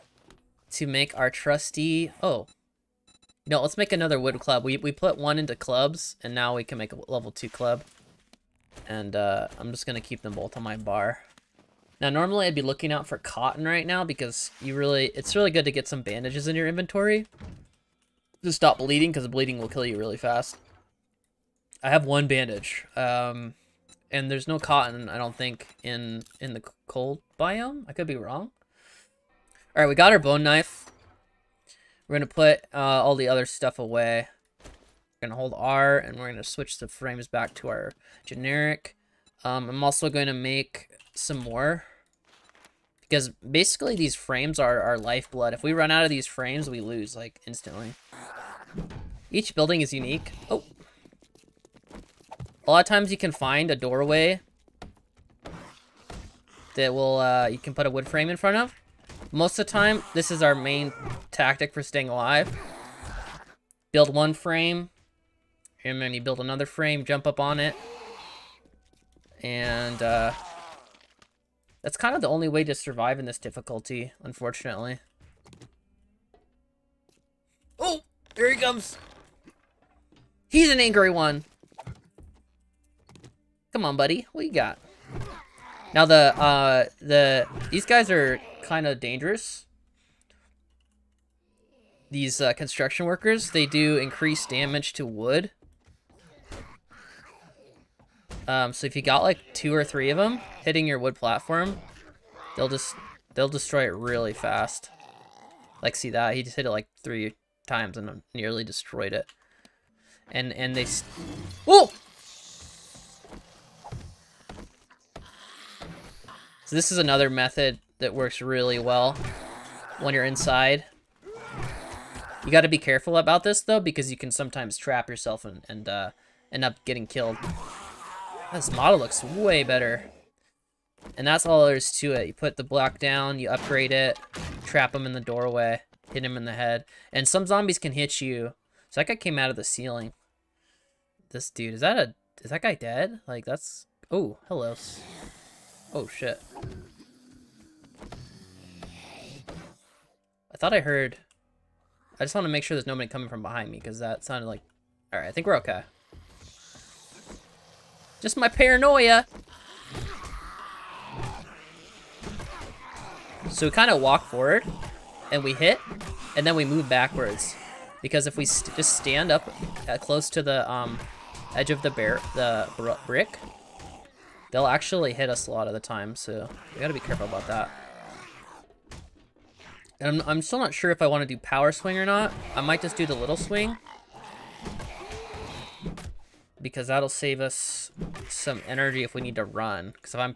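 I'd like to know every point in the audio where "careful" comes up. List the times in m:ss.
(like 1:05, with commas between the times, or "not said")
2:02, 2:56.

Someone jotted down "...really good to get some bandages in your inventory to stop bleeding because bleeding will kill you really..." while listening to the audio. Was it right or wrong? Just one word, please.
right.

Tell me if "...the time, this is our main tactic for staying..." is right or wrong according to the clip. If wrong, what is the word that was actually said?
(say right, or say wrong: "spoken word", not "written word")
right.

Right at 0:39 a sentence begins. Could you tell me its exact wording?
Um, I'm also going to make some more.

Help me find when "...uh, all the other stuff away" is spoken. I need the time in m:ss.
0:32.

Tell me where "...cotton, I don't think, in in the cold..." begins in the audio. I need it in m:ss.
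0:24.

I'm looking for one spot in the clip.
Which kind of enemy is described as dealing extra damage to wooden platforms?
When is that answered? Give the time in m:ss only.
1:32.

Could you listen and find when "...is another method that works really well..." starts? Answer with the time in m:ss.
1:56.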